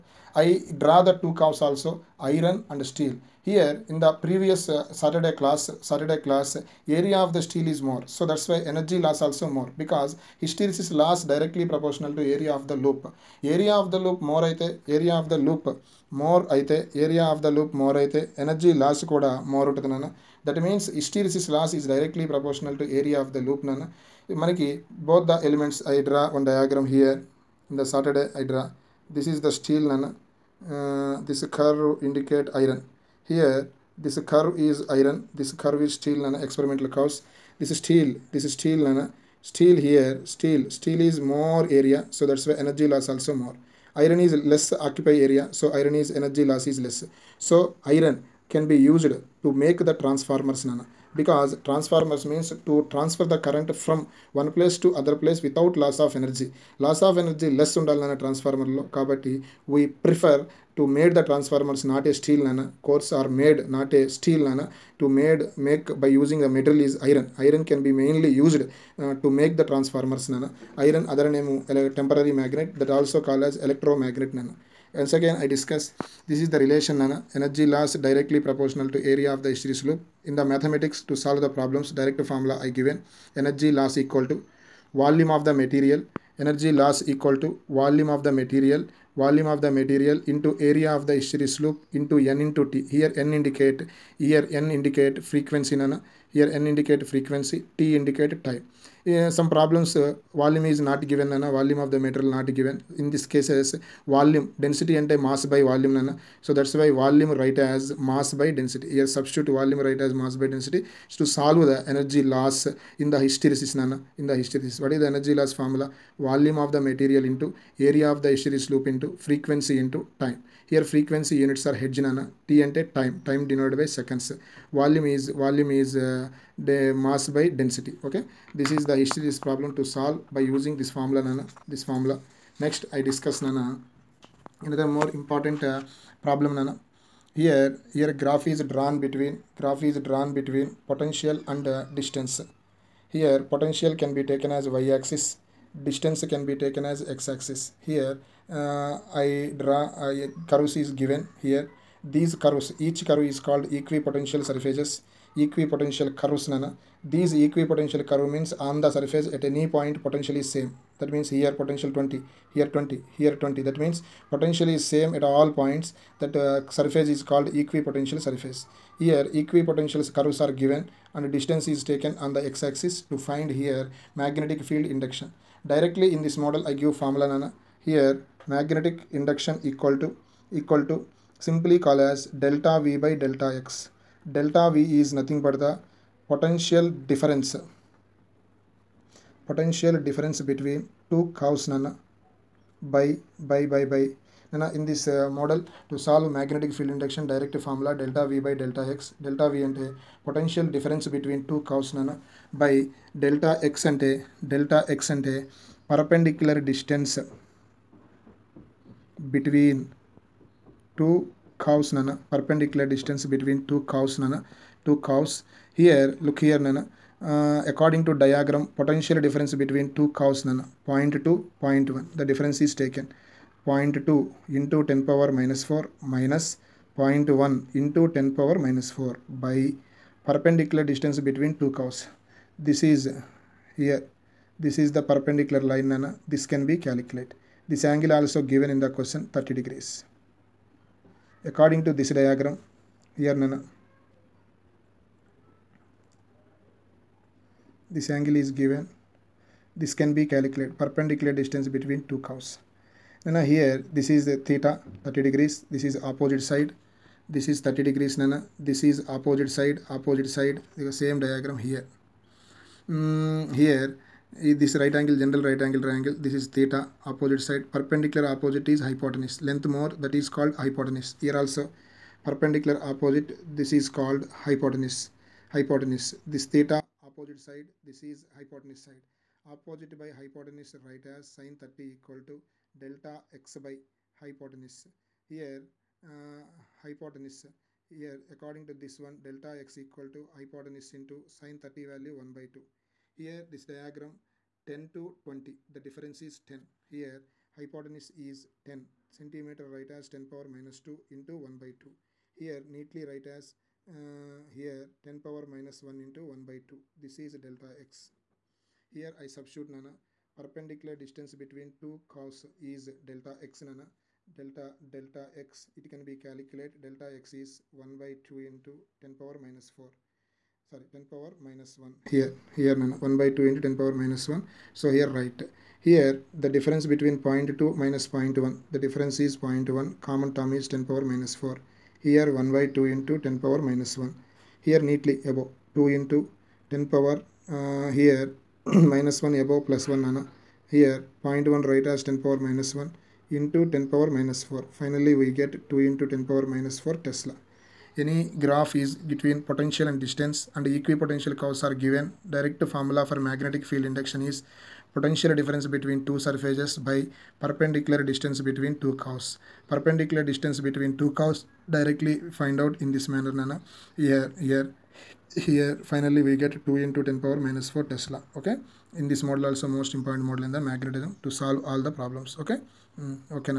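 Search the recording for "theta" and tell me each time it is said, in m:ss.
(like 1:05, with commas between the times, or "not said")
4:14, 4:26, 4:36.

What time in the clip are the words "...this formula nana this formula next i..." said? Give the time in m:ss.
2:10.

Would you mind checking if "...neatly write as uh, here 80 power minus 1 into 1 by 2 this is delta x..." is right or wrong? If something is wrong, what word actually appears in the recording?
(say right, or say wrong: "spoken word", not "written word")
wrong: "10", not "80".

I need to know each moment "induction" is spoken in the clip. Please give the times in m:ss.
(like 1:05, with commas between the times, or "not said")
2:54, 2:59, 3:16, 5:53.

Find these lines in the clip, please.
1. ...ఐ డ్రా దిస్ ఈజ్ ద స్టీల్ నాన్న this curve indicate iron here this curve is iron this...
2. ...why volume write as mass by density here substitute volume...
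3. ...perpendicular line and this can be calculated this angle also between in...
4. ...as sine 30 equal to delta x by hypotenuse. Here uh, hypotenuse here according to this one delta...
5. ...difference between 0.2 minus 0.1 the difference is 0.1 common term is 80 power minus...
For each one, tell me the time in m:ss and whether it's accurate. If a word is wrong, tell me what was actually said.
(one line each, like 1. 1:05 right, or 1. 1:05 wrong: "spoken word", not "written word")
1. 0:28 right
2. 1:46 right
3. 3:55 wrong: "given", not "between"
4. 4:41 right
5. 5:26 wrong: "10", not "80".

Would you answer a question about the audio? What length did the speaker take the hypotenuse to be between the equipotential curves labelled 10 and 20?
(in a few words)
10 centimeters.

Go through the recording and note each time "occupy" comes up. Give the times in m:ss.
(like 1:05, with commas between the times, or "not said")
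0:44.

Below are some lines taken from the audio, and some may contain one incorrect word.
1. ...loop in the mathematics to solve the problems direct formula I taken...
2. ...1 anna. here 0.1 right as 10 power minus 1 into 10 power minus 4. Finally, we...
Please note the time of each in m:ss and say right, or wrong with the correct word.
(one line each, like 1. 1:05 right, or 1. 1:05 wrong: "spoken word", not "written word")
1. 1:19 wrong: "given", not "taken"
2. 5:39 right.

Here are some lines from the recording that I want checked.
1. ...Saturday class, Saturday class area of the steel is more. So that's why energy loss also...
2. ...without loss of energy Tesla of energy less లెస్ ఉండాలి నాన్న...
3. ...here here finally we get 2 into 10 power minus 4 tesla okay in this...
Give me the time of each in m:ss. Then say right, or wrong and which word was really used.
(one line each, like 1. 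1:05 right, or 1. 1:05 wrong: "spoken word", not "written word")
1. 0:04 right
2. 0:55 wrong: "Loss", not "Tesla"
3. 6:04 right.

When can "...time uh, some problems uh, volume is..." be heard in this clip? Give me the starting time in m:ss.
1:38.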